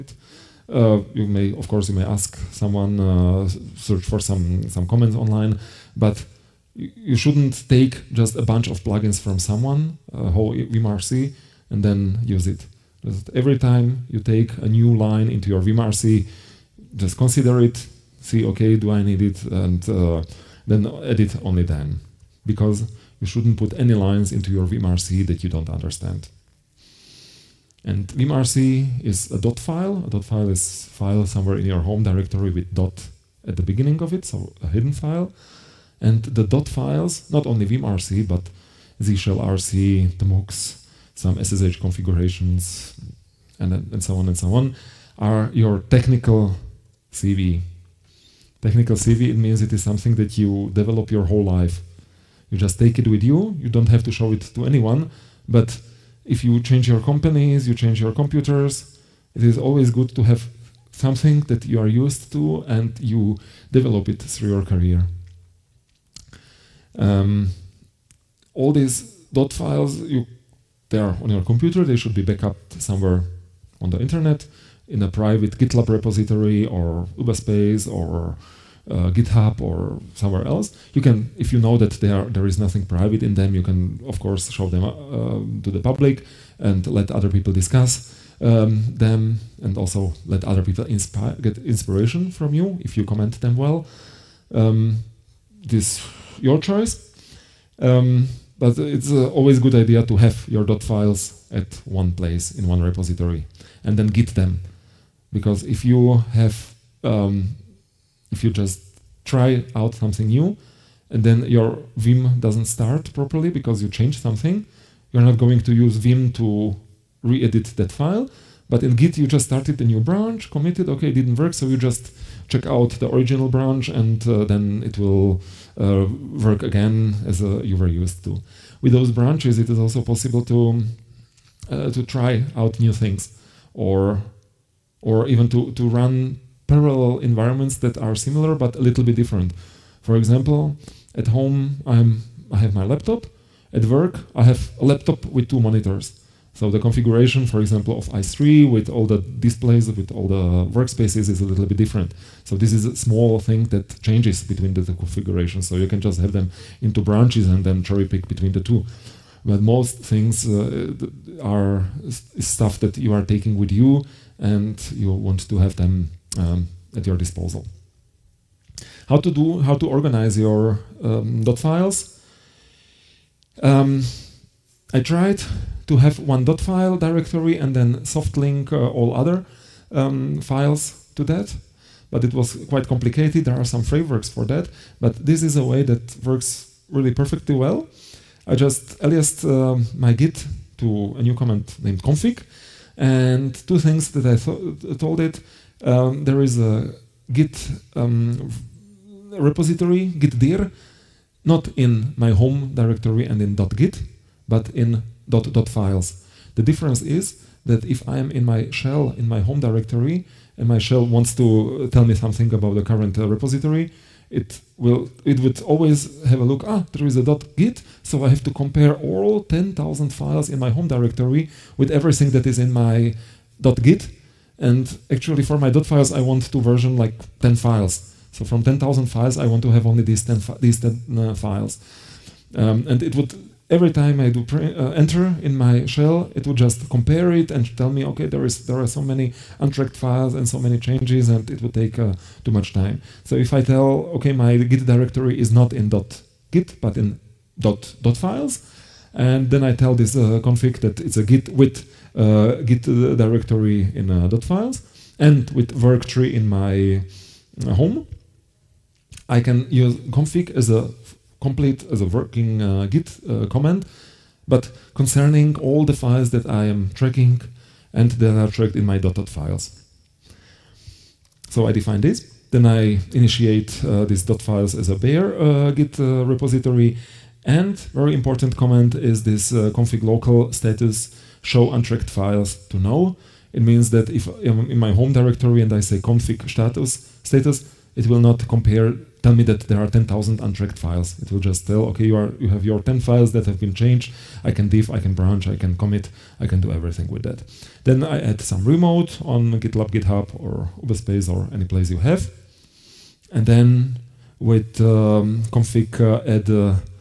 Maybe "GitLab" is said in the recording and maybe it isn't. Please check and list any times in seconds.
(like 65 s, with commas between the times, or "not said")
75 s, 299 s.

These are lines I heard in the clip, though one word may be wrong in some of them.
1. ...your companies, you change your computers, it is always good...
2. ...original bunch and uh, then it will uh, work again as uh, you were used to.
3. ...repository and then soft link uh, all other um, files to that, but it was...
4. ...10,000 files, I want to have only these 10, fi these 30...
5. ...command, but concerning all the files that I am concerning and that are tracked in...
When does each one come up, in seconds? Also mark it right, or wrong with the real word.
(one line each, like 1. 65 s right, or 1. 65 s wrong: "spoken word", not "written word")
1. 56 s right
2. 123 s wrong: "branch", not "bunch"
3. 176 s wrong: "directory", not "repository"
4. 228 s wrong: "10", not "30"
5. 263 s wrong: "tracking", not "concerning".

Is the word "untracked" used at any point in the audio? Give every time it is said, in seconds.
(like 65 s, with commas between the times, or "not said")
239 s, 281 s, 290 s.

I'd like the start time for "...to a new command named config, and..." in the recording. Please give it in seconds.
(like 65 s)
190 s.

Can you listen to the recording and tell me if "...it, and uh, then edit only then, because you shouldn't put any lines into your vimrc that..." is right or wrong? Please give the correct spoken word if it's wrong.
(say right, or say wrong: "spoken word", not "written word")
right.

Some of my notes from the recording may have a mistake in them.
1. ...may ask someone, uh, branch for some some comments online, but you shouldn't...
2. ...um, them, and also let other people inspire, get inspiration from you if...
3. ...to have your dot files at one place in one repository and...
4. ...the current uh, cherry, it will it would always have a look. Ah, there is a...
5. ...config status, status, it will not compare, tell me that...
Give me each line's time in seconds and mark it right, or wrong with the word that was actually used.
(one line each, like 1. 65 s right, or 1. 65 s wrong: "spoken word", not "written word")
1. 1 s wrong: "search", not "branch"
2. 88 s right
3. 100 s right
4. 212 s wrong: "repository", not "cherry"
5. 285 s right.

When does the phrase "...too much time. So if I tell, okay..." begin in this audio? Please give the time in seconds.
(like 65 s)
242 s.